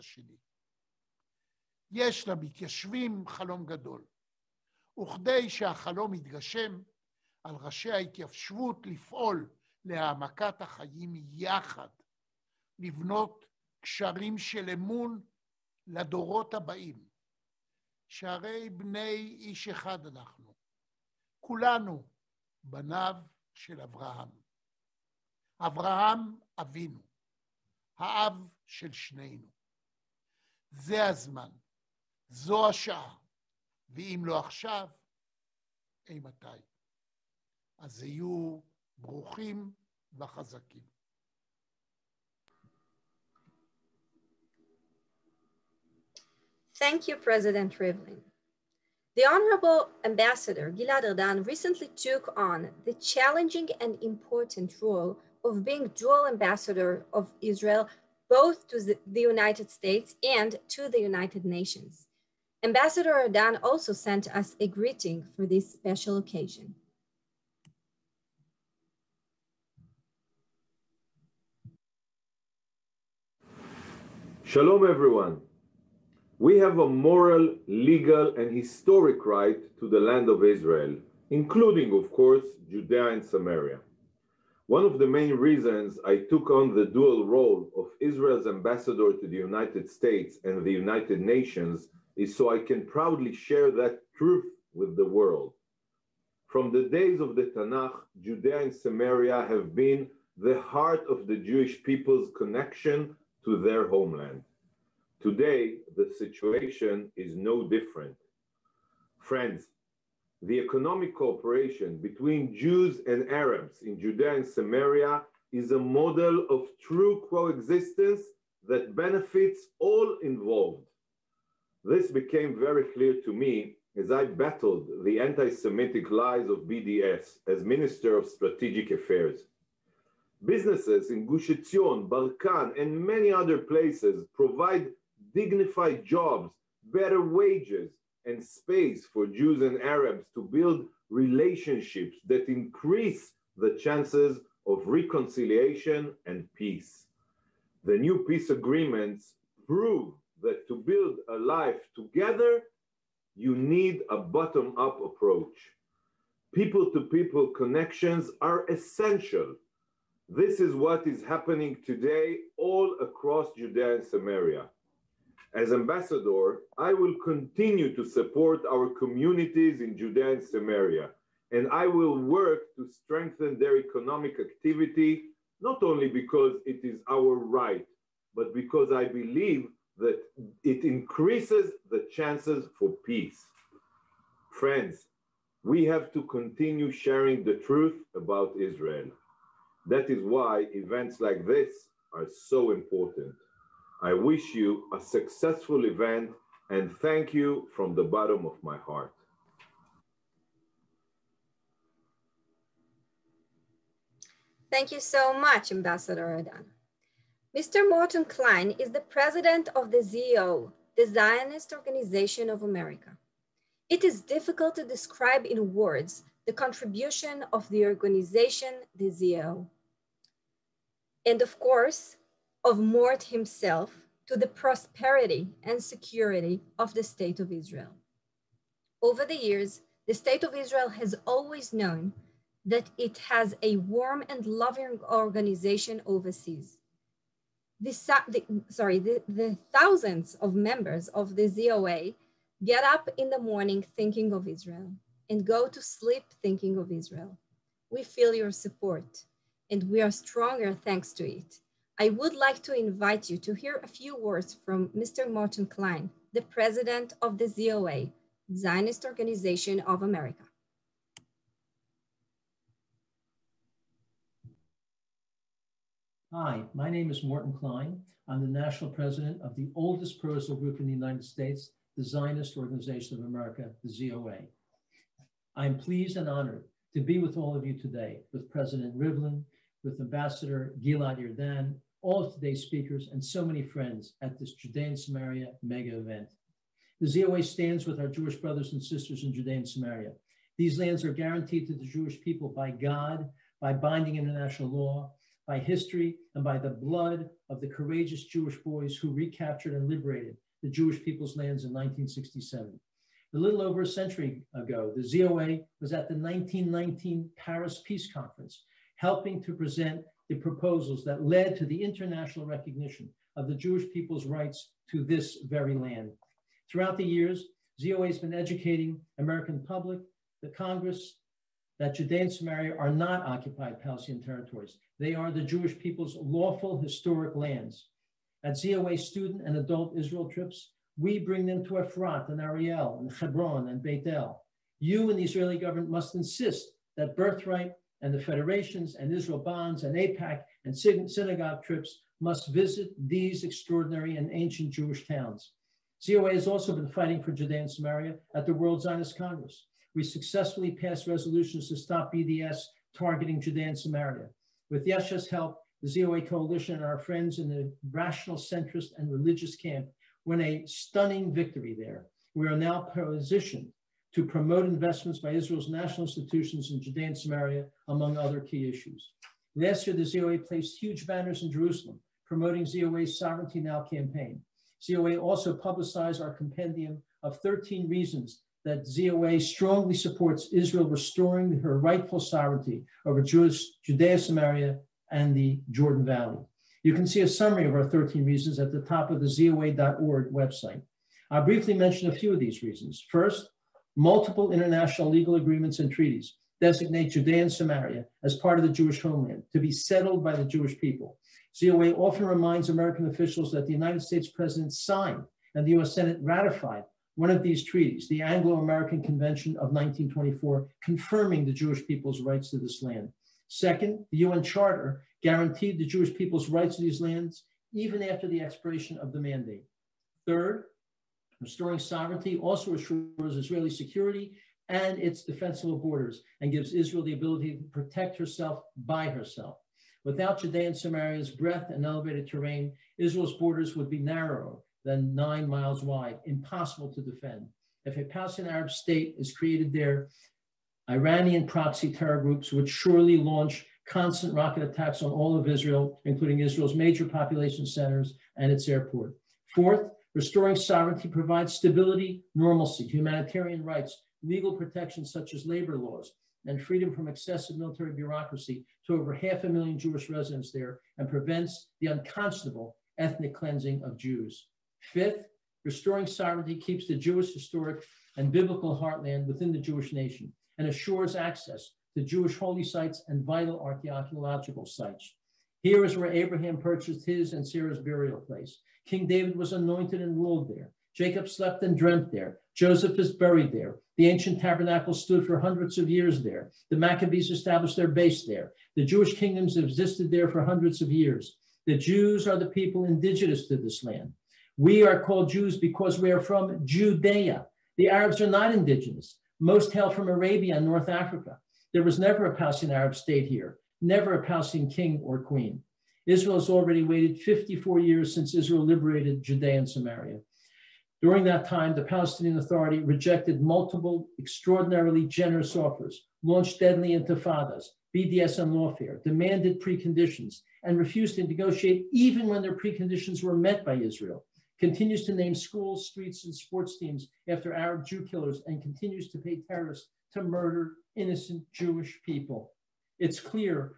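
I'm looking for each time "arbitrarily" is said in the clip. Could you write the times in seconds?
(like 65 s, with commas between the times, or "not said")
not said.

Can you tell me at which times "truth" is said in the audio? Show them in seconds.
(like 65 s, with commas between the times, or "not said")
94 s, 187 s.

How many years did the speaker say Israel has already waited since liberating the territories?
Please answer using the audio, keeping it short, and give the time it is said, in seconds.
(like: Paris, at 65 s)
54, at 507 s.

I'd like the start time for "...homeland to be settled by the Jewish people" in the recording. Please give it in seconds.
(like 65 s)
399 s.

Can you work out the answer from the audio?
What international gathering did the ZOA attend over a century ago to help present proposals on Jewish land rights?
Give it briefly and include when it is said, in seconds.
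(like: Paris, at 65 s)
1919 Paris Peace Conference, at 306 s.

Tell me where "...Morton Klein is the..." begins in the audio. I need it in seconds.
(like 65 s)
207 s.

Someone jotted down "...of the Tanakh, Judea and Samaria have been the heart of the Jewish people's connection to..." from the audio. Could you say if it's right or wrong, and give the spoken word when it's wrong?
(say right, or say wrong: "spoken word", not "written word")
right.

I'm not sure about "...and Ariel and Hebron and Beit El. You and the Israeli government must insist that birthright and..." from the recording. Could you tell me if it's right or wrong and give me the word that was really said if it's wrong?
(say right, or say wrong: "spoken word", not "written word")
right.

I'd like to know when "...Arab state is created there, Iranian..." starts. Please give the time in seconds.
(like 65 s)
438 s.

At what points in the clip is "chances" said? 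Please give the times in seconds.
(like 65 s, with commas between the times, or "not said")
143 s, 182 s.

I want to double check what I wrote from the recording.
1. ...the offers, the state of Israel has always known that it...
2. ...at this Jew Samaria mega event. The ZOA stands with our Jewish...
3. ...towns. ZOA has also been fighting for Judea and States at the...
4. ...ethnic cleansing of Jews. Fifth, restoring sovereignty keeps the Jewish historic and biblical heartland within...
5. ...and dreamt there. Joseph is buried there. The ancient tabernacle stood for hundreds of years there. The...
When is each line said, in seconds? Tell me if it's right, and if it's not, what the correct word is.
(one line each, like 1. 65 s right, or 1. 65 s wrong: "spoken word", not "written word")
1. 229 s wrong: "years", not "offers"
2. 284 s wrong: "Judean", not "Jew"
3. 345 s wrong: "Samaria", not "States"
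4. 462 s right
5. 481 s right.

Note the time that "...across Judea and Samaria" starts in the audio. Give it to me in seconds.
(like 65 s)
163 s.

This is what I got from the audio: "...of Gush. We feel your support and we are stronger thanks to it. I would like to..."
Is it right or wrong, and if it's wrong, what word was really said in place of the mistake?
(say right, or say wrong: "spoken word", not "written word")
wrong: "Israel", not "Gush".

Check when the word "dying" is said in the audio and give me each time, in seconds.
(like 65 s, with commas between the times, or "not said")
not said.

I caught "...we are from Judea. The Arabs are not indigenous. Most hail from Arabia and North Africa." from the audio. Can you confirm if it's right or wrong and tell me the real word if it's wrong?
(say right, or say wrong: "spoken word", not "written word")
right.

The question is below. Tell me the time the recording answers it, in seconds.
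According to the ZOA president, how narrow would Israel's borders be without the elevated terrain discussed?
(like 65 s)
435 s.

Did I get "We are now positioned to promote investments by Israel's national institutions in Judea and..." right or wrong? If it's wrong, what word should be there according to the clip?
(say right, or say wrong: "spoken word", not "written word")
right.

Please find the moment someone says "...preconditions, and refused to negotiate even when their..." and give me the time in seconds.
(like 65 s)
519 s.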